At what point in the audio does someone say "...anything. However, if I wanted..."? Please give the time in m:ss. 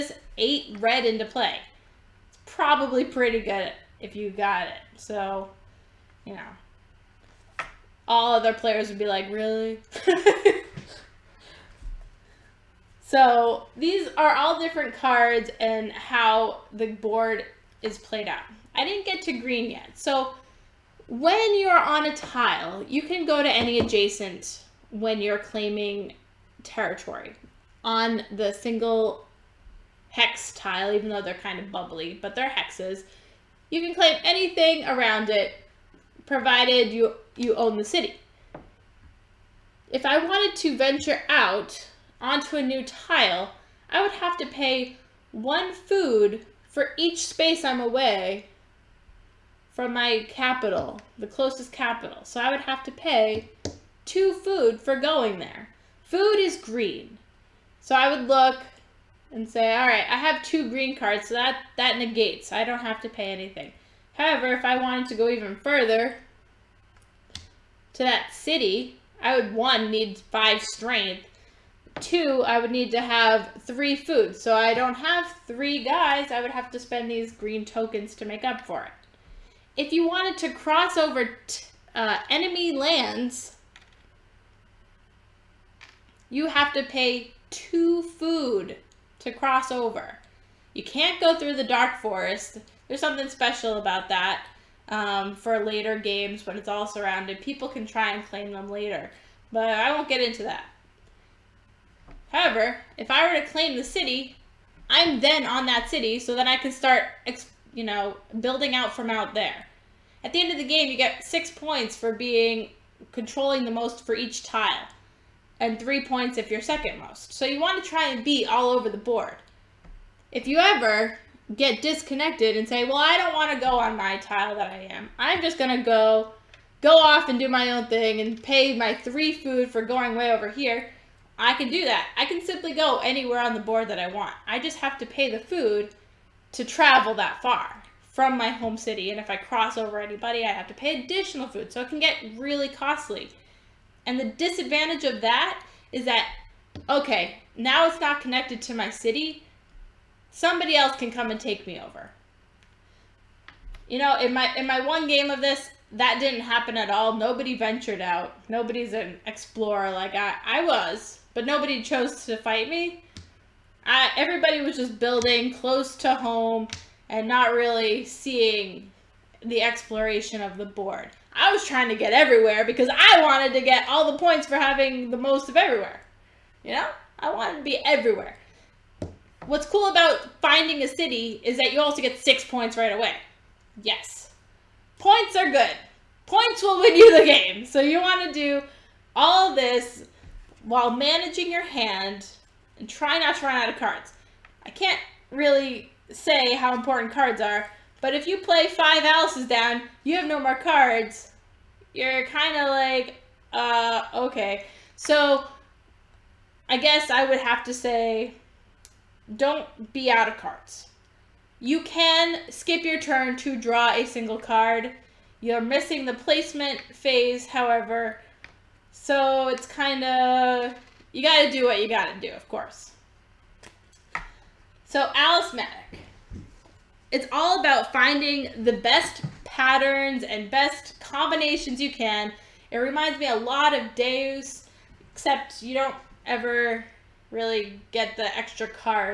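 1:03.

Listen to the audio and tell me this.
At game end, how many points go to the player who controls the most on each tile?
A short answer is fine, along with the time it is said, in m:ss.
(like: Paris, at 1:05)
6 points, at 1:51.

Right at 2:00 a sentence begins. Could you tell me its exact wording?
If you ever get disconnected and say, well, I don't want to go on my tile that I am.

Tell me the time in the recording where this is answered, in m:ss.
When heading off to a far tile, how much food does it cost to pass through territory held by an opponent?
1:26.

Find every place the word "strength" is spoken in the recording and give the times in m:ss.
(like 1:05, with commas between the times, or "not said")
1:10.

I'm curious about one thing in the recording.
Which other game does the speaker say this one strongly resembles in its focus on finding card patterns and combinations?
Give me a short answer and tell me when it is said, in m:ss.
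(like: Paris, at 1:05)
Deus, at 3:53.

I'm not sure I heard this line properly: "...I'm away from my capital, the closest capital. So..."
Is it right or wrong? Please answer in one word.
right.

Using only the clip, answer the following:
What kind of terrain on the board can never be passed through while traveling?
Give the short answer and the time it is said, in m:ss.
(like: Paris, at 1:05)
Dark forest, at 1:31.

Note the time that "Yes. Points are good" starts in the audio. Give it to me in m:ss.
3:03.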